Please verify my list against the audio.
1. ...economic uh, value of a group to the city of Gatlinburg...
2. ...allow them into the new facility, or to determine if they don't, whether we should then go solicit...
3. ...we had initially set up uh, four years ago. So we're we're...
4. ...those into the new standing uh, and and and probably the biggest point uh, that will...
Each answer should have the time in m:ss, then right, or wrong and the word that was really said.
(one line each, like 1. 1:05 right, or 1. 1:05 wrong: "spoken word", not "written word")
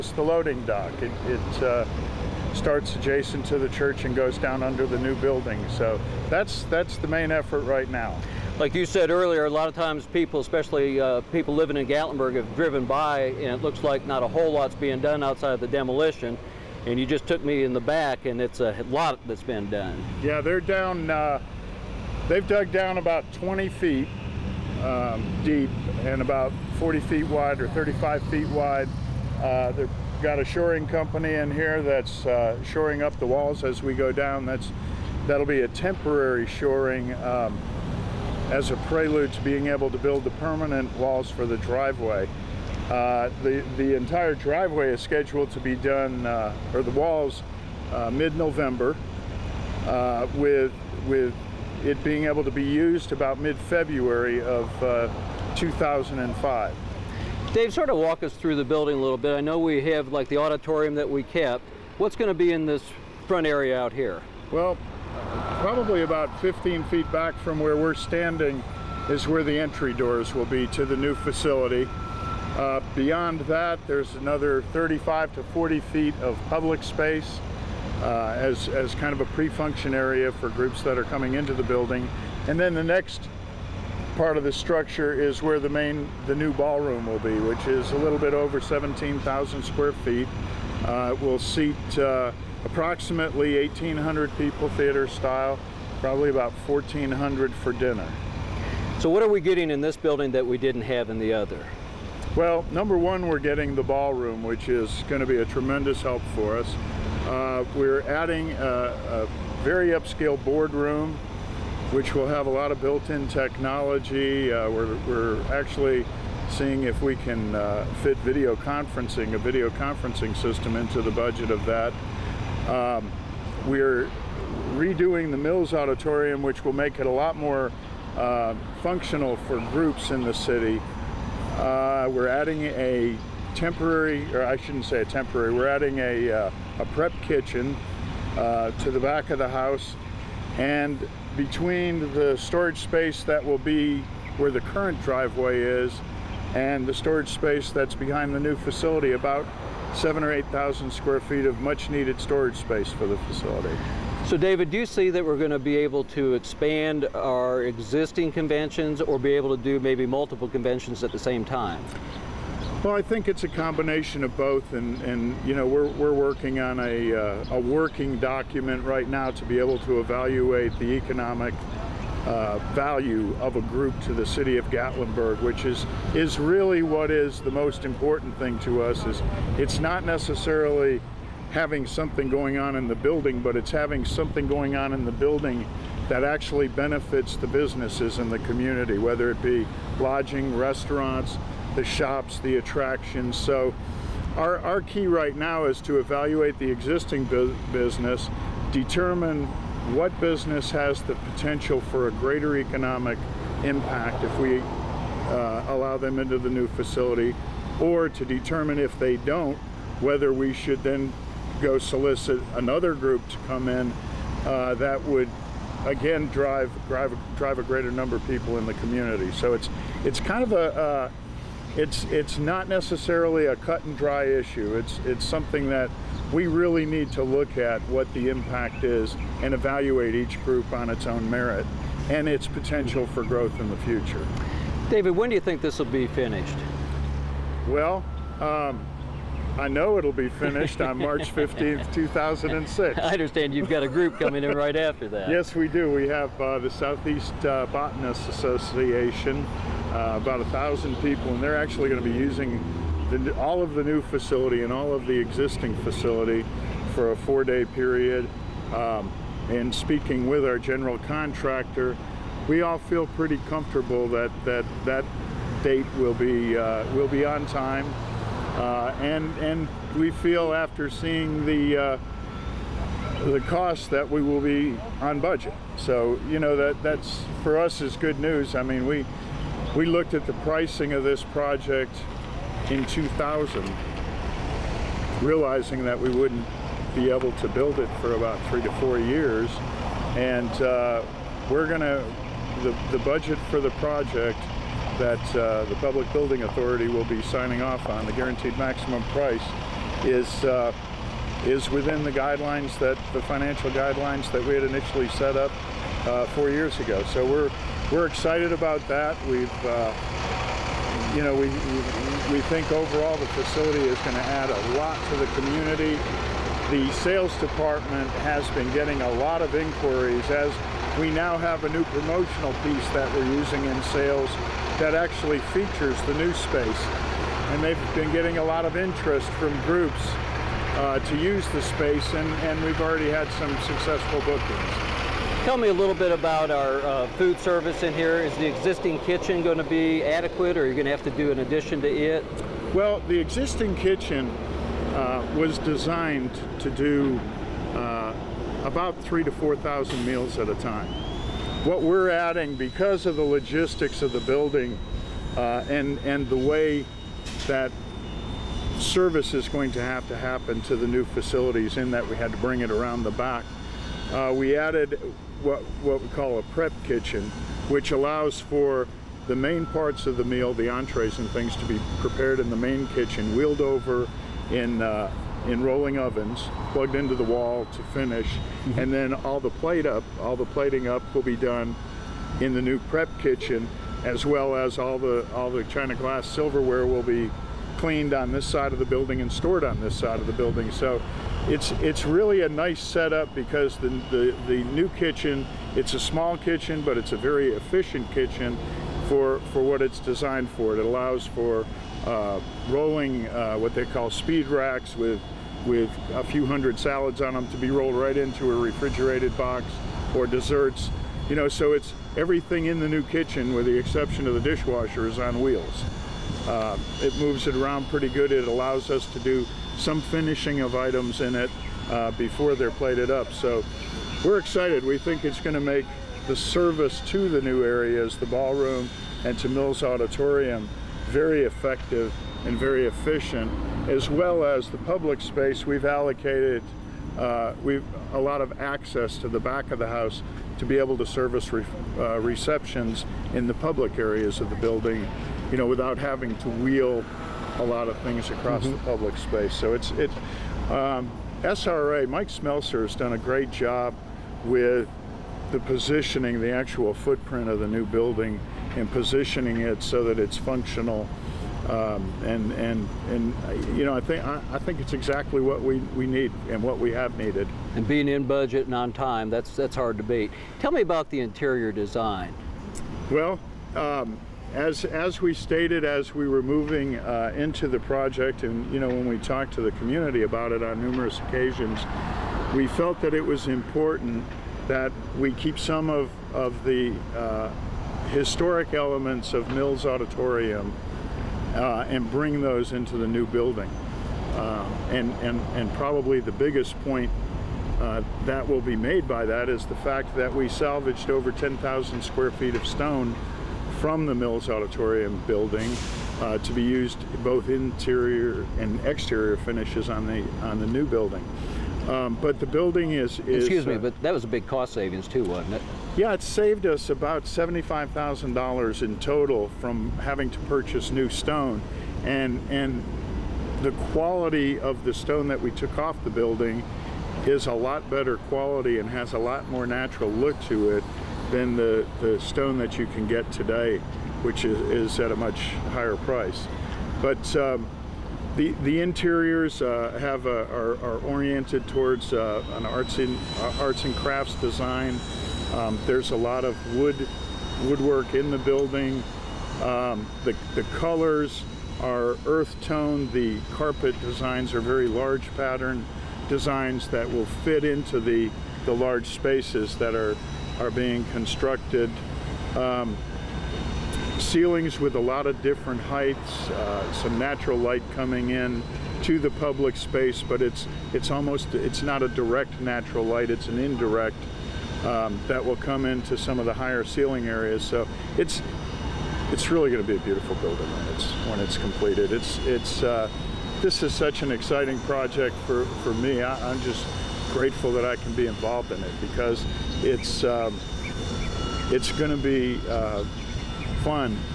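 1. 2:50 right
2. 3:25 right
3. 5:04 right
4. 8:12 wrong: "building", not "standing".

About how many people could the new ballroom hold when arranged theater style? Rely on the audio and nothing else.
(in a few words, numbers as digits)
1,800.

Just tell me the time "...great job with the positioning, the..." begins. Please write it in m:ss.
7:33.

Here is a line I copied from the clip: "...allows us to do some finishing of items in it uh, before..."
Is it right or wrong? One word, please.
right.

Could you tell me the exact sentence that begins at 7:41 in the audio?
Um, and and and you know I think I, I think it's exactly what we, we need and what we have needed.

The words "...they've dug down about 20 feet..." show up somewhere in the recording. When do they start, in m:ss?
0:22.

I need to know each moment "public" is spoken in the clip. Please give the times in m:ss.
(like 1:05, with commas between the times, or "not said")
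1:16, 4:55, 7:14, 7:23, 7:28, 9:29.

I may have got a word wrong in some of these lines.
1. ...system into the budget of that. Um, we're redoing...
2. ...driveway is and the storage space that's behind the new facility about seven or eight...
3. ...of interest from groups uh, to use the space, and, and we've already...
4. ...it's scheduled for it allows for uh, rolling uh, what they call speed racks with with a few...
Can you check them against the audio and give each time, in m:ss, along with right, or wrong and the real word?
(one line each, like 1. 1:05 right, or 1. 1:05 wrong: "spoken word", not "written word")
1. 2:00 right
2. 2:25 right
3. 5:28 right
4. 6:39 wrong: "designed", not "scheduled".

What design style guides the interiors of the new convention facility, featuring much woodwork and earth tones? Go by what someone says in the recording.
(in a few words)
arts and crafts.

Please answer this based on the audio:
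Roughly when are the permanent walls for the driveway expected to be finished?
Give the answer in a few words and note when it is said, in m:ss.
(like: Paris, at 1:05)
mid-November, at 0:48.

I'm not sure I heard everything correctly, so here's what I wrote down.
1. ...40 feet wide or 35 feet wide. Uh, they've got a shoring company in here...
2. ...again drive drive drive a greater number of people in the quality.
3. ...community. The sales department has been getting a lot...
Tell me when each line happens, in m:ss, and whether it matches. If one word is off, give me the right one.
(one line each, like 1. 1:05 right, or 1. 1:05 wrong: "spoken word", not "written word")
1. 0:26 right
2. 3:35 wrong: "community", not "quality"
3. 5:15 right.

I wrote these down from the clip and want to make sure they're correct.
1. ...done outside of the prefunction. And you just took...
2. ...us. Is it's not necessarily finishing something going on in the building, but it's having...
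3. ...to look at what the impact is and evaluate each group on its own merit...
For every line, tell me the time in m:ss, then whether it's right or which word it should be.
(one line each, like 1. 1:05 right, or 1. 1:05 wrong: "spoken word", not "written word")
1. 0:14 wrong: "demolition", not "prefunction"
2. 2:58 wrong: "having", not "finishing"
3. 3:47 right.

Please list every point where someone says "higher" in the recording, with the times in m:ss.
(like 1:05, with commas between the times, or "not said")
8:55, 9:36.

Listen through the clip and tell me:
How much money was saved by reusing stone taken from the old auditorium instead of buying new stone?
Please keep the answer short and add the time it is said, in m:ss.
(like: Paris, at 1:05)
$75,000, at 8:37.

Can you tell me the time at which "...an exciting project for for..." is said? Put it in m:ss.
9:44.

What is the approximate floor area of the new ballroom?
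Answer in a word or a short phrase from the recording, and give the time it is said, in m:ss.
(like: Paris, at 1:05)
17,000 square feet, at 1:28.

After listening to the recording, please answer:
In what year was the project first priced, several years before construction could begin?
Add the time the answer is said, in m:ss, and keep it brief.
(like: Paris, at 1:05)
2000, at 4:42.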